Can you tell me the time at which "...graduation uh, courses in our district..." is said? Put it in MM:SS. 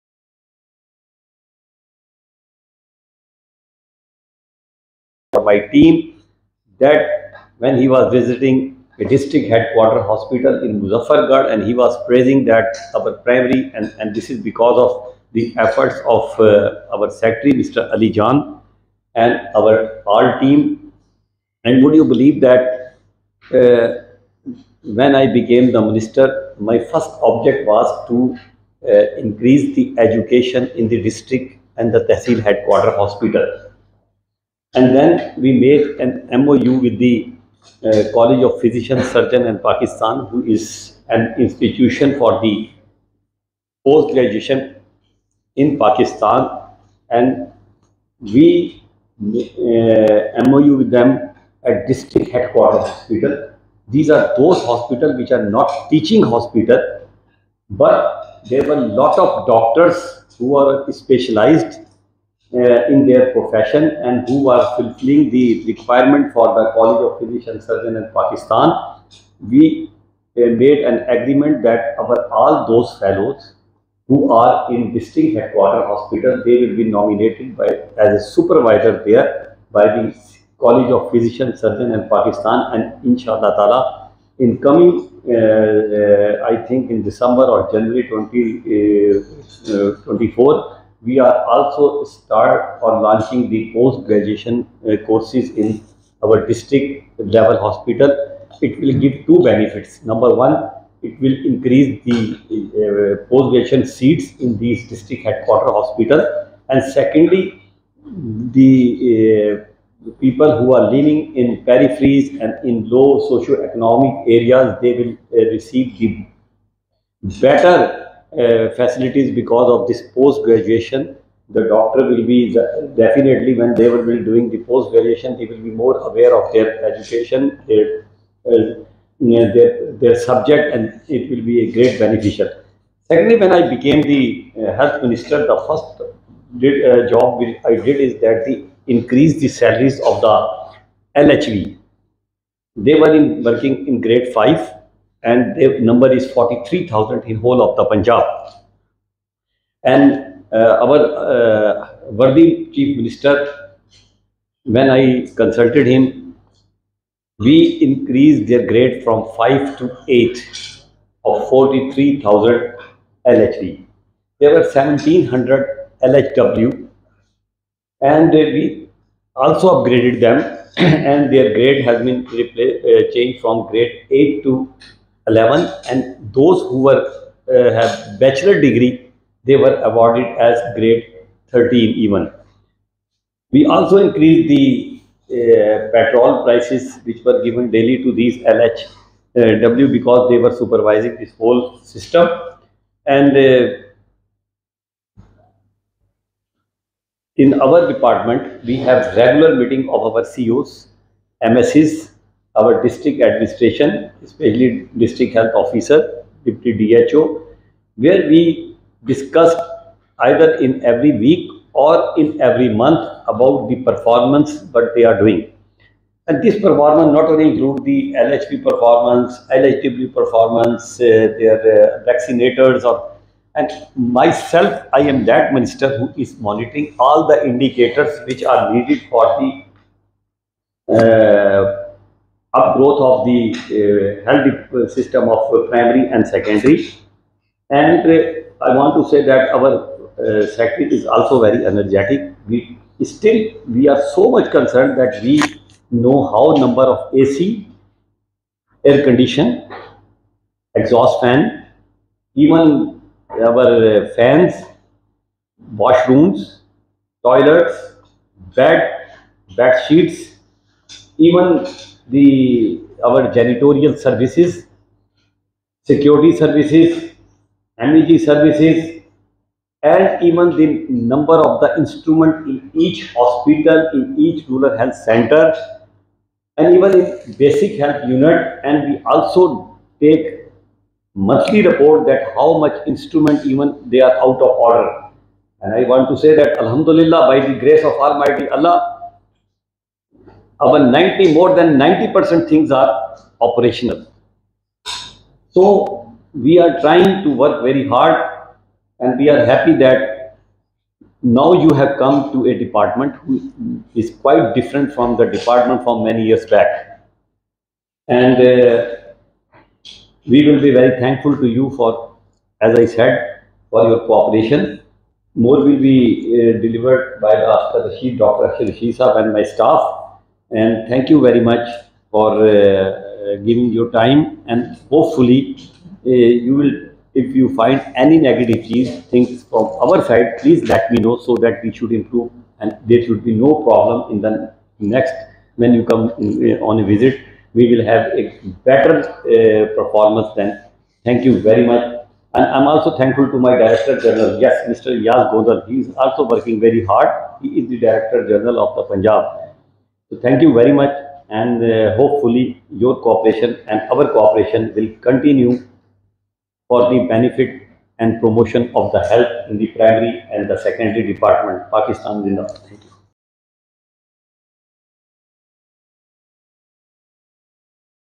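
01:34.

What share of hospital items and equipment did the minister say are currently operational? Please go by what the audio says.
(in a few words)
More than 90%.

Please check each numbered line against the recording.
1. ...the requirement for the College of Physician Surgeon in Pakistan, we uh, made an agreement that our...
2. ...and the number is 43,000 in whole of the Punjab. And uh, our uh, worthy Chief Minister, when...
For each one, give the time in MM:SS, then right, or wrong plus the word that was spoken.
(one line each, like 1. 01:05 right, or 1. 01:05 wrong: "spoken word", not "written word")
1. 01:05 right
2. 02:25 right.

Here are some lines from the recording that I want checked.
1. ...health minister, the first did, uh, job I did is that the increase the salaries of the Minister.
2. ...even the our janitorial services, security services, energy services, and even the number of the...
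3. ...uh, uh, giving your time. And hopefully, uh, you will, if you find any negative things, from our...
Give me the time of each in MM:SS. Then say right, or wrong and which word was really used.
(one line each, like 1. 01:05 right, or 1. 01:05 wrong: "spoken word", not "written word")
1. 02:14 wrong: "LHV", not "Minister"
2. 04:21 right
3. 05:22 right.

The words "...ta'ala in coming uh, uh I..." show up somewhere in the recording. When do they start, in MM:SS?
01:23.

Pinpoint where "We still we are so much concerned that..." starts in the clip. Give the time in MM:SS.
04:02.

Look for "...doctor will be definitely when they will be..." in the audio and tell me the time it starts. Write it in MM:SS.
02:01.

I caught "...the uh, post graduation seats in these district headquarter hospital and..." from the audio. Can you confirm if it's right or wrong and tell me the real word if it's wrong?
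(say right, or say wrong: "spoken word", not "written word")
right.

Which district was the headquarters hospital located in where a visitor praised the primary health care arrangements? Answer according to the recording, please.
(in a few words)
Muzaffargarh.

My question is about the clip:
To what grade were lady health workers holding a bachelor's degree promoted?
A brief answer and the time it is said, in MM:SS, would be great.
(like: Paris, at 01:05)
Grade 13, at 03:00.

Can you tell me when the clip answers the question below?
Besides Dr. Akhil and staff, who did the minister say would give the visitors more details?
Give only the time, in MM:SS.
05:17.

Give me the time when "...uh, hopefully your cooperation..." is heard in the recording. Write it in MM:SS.
05:51.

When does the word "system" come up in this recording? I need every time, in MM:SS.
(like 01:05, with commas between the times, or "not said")
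03:11, 03:54.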